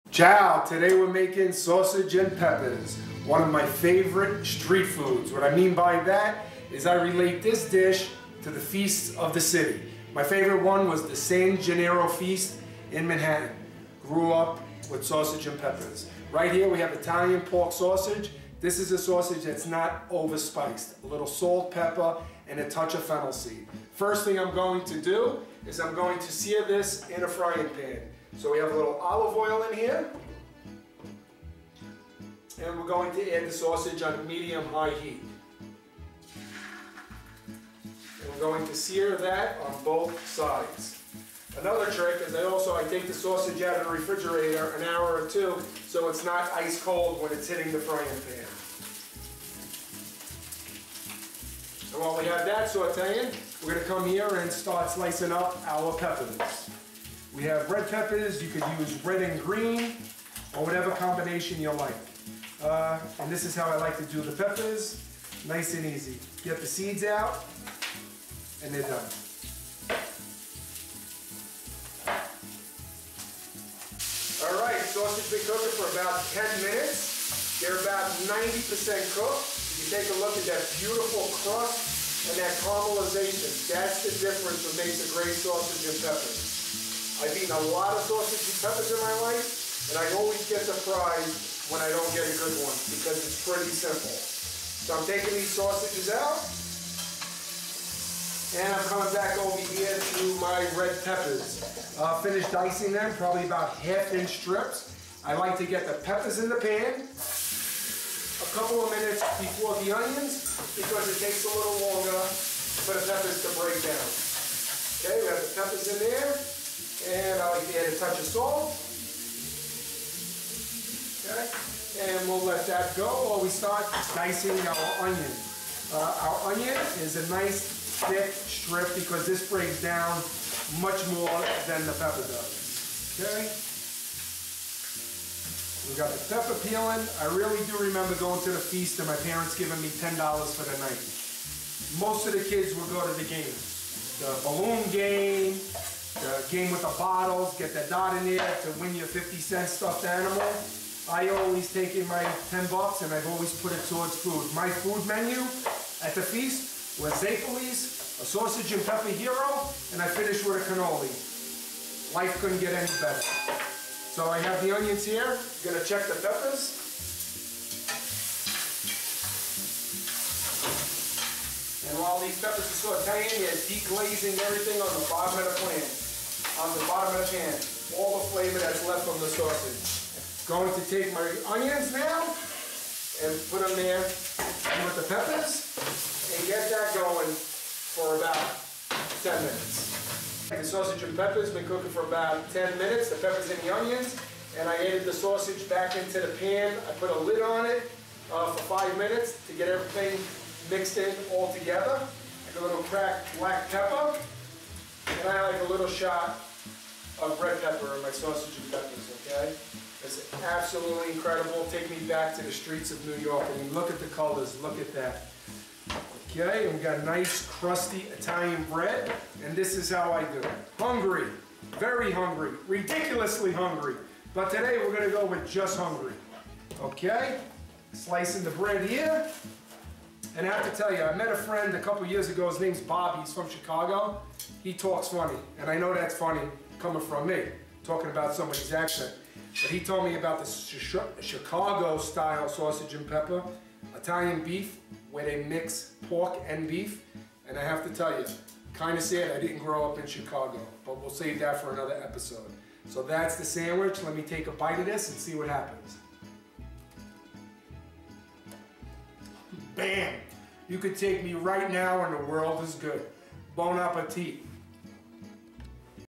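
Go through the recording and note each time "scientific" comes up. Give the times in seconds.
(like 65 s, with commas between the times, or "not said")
not said.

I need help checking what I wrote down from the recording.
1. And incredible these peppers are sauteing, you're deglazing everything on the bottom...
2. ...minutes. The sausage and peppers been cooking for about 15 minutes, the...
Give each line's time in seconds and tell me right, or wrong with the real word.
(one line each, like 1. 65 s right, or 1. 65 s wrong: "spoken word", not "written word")
1. 171 s wrong: "while", not "incredible"
2. 189 s wrong: "10", not "15".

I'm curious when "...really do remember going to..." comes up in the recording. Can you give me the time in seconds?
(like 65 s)
137 s.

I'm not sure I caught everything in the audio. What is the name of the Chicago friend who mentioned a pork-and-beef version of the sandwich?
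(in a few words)
Bobby.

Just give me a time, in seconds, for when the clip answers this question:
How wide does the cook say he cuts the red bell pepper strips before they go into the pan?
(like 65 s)
103 s.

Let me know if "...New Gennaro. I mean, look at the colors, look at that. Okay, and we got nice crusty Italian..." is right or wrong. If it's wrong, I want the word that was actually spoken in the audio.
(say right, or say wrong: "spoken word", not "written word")
wrong: "York", not "Gennaro".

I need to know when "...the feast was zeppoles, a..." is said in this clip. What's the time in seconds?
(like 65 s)
156 s.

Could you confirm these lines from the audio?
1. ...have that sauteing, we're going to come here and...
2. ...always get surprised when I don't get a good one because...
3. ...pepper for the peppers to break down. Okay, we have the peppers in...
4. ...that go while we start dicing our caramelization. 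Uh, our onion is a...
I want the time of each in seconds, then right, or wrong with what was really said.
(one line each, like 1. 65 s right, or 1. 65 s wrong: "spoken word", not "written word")
1. 52 s right
2. 90 s right
3. 111 s wrong: "longer", not "pepper"
4. 122 s wrong: "onion", not "caramelization".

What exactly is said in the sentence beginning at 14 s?
Grew up with sausage and peppers.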